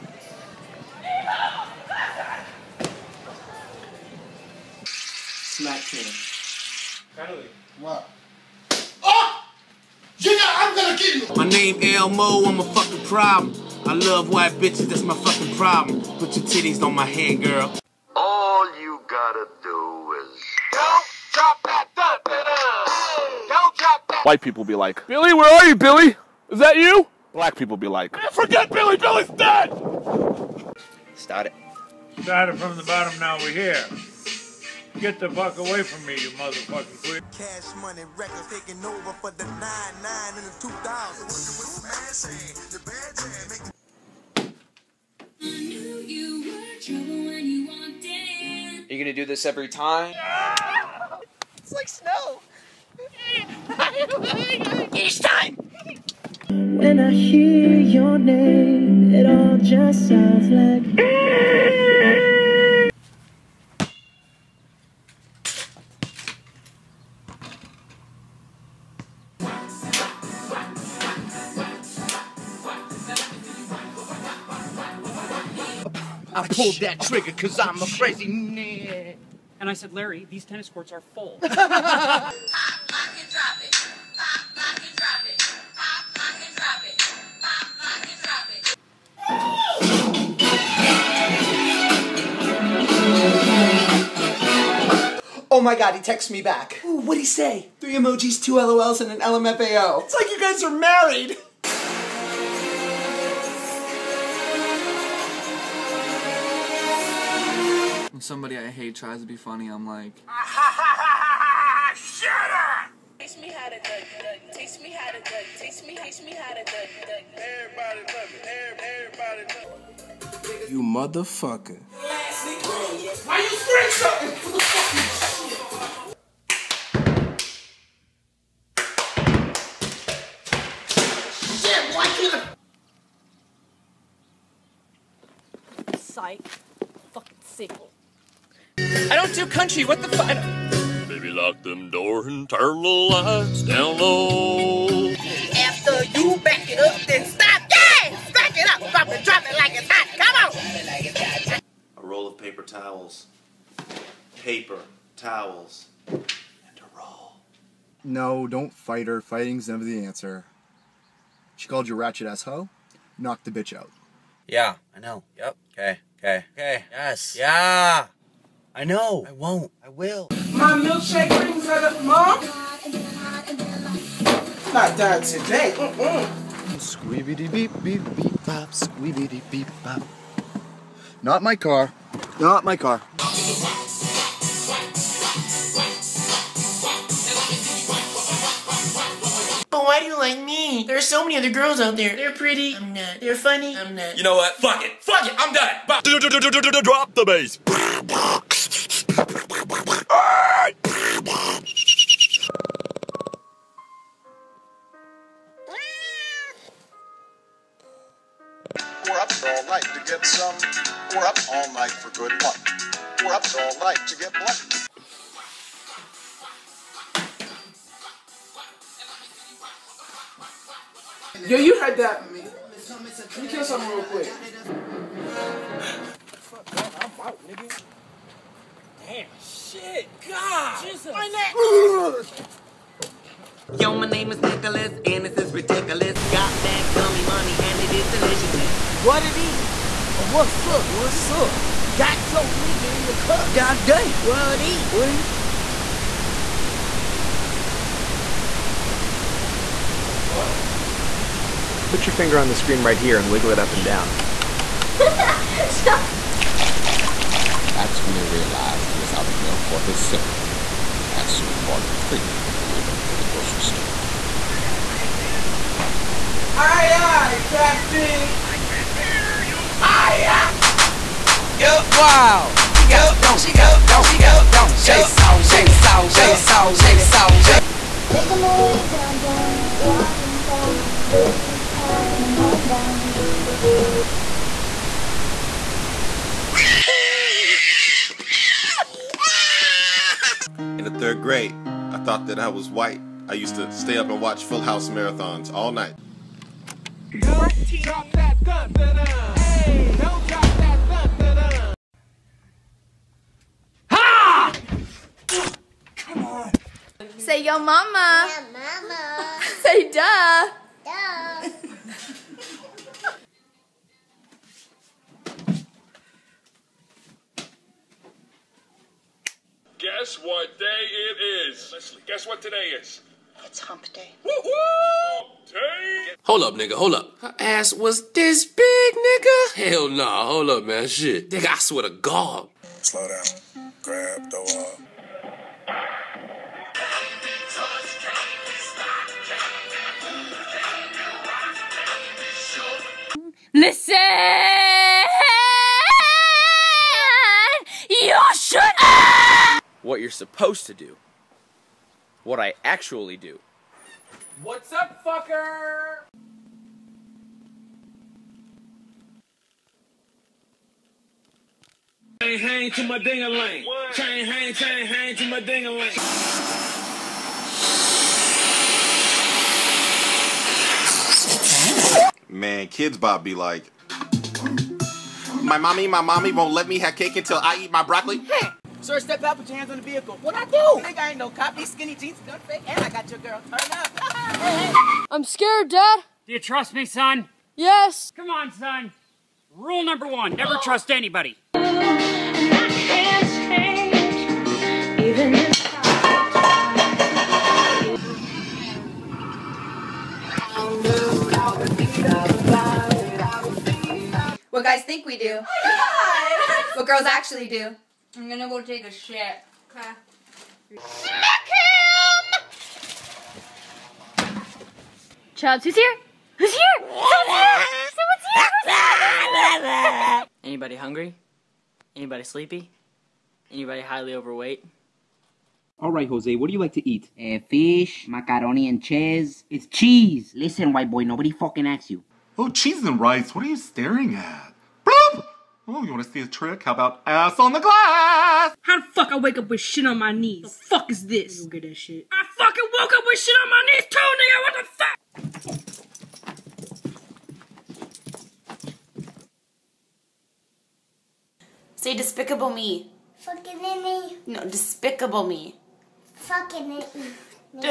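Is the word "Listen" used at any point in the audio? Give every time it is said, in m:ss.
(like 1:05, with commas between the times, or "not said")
7:10.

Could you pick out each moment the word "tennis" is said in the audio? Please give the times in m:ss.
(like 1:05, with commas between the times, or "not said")
1:20.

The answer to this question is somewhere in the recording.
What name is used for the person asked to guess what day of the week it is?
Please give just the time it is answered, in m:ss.
5:21.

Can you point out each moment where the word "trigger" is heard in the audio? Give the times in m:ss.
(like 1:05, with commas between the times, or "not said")
1:17.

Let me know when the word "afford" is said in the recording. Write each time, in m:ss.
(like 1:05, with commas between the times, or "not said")
not said.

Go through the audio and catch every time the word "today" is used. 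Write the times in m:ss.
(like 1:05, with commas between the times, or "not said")
2:55, 5:22.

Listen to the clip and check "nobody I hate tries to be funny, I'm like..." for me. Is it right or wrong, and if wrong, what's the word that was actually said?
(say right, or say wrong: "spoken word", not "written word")
wrong: "somebody", not "nobody".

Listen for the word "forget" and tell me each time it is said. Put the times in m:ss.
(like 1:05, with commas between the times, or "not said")
0:28.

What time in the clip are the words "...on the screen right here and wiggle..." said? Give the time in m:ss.
4:12.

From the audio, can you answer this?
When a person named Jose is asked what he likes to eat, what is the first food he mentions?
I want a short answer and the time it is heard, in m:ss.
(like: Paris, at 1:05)
fish, at 7:07.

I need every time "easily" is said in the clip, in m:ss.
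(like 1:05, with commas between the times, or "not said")
not said.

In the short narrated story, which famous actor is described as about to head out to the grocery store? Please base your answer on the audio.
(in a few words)
Morgan Freeman.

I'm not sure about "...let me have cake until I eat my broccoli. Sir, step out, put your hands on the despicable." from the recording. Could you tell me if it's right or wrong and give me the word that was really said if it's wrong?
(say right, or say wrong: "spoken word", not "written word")
wrong: "vehicle", not "despicable".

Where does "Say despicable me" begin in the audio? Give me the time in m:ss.
7:31.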